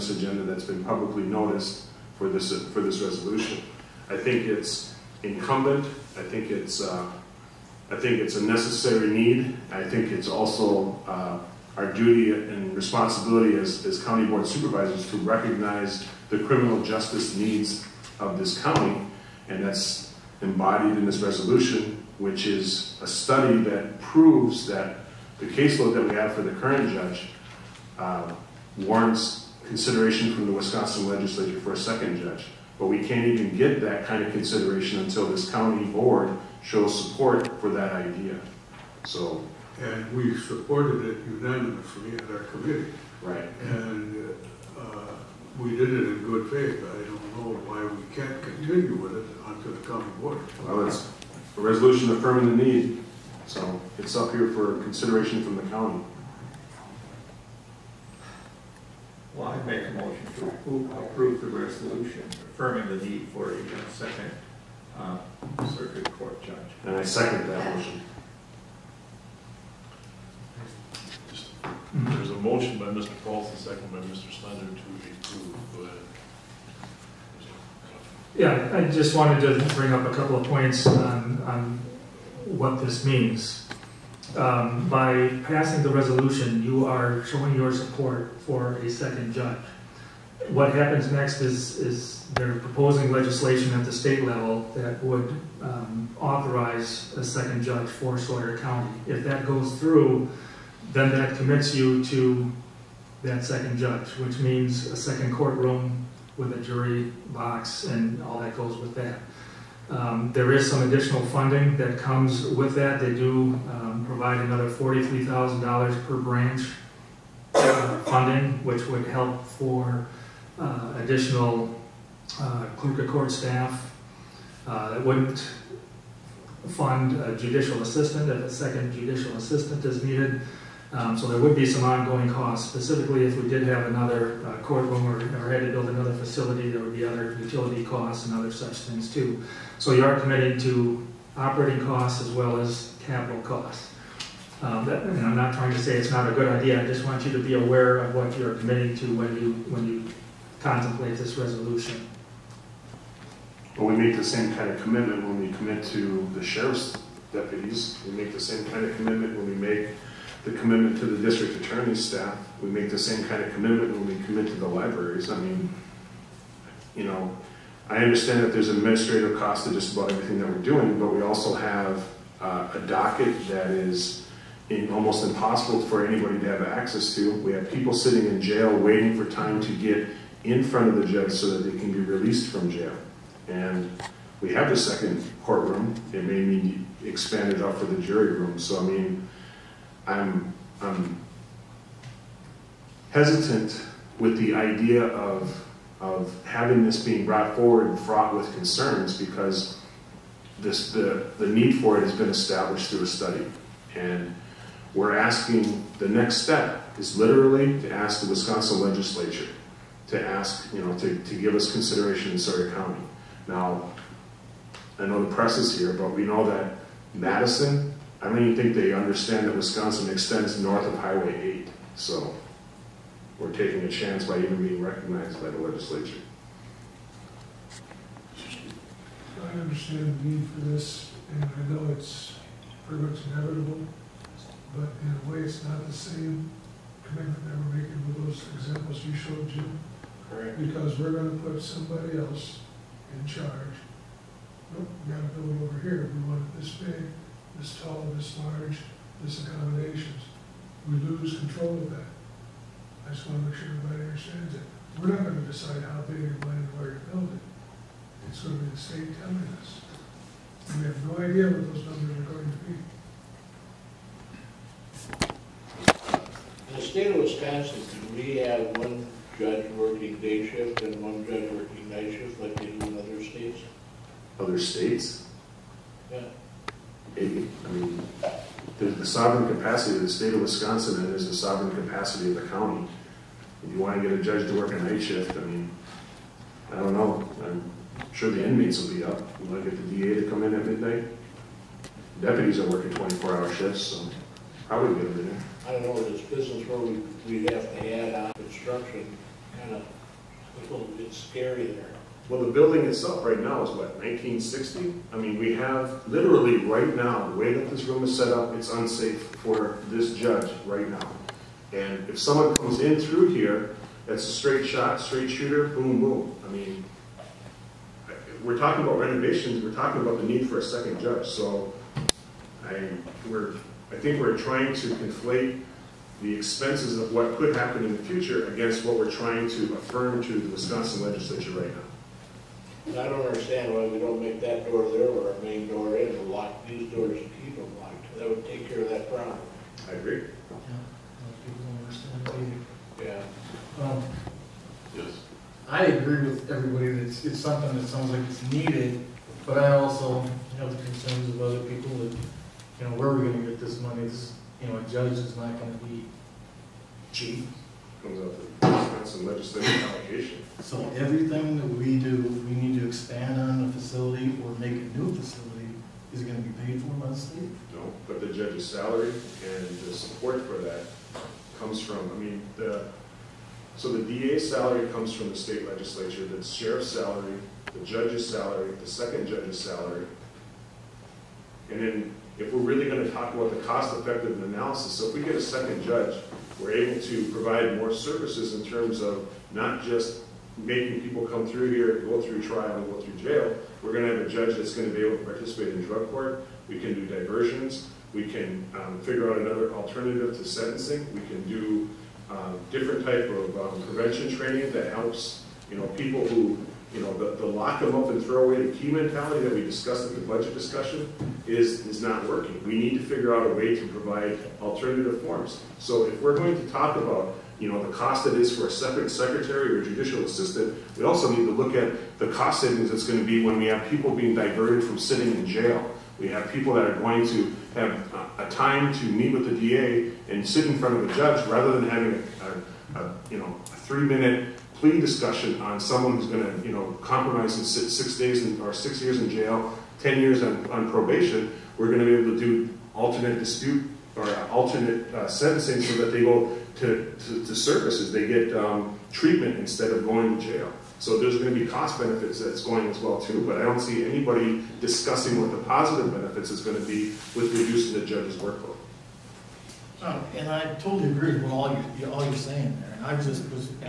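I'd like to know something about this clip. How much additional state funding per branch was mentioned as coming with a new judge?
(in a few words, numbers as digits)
$43,000.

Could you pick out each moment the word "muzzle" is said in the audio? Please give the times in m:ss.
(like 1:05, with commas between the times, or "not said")
not said.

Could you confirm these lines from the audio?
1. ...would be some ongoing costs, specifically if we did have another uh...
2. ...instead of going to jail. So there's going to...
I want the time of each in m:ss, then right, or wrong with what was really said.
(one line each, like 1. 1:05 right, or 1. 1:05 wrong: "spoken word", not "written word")
1. 2:11 right
2. 7:29 right.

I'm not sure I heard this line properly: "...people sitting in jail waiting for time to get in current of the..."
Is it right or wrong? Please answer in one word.
wrong.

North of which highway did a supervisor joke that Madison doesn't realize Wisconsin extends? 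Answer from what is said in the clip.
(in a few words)
Highway 8.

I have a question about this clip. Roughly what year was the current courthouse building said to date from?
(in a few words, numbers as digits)
1960.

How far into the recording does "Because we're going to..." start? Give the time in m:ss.
4:00.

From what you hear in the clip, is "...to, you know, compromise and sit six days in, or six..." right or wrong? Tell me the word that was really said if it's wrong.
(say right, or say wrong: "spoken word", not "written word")
right.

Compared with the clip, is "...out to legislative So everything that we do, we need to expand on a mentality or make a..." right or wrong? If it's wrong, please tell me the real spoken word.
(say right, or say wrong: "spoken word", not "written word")
wrong: "facility", not "mentality".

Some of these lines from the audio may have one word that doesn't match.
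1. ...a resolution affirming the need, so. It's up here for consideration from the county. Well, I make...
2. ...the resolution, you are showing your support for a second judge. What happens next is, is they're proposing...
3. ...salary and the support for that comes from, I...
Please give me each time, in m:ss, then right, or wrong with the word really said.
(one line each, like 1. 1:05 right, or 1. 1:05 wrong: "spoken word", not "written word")
1. 0:51 right
2. 1:25 right
3. 6:08 right.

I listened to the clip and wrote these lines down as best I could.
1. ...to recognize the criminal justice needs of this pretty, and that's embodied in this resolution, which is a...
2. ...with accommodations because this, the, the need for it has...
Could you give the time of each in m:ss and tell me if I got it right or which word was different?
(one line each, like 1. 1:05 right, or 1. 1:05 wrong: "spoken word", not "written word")
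1. 0:15 wrong: "county", not "pretty"
2. 3:18 wrong: "concerns", not "accommodations".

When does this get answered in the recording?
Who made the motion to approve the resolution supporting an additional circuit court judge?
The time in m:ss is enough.
1:12.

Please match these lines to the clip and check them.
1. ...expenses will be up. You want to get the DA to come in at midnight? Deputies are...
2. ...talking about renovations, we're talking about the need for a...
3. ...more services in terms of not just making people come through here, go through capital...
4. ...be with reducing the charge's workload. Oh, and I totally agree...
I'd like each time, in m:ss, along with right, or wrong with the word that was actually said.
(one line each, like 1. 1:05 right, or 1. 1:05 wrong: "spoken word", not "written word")
1. 4:48 wrong: "inmates", not "expenses"
2. 5:18 right
3. 6:27 wrong: "trial", not "capital"
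4. 7:36 wrong: "judge", not "charge".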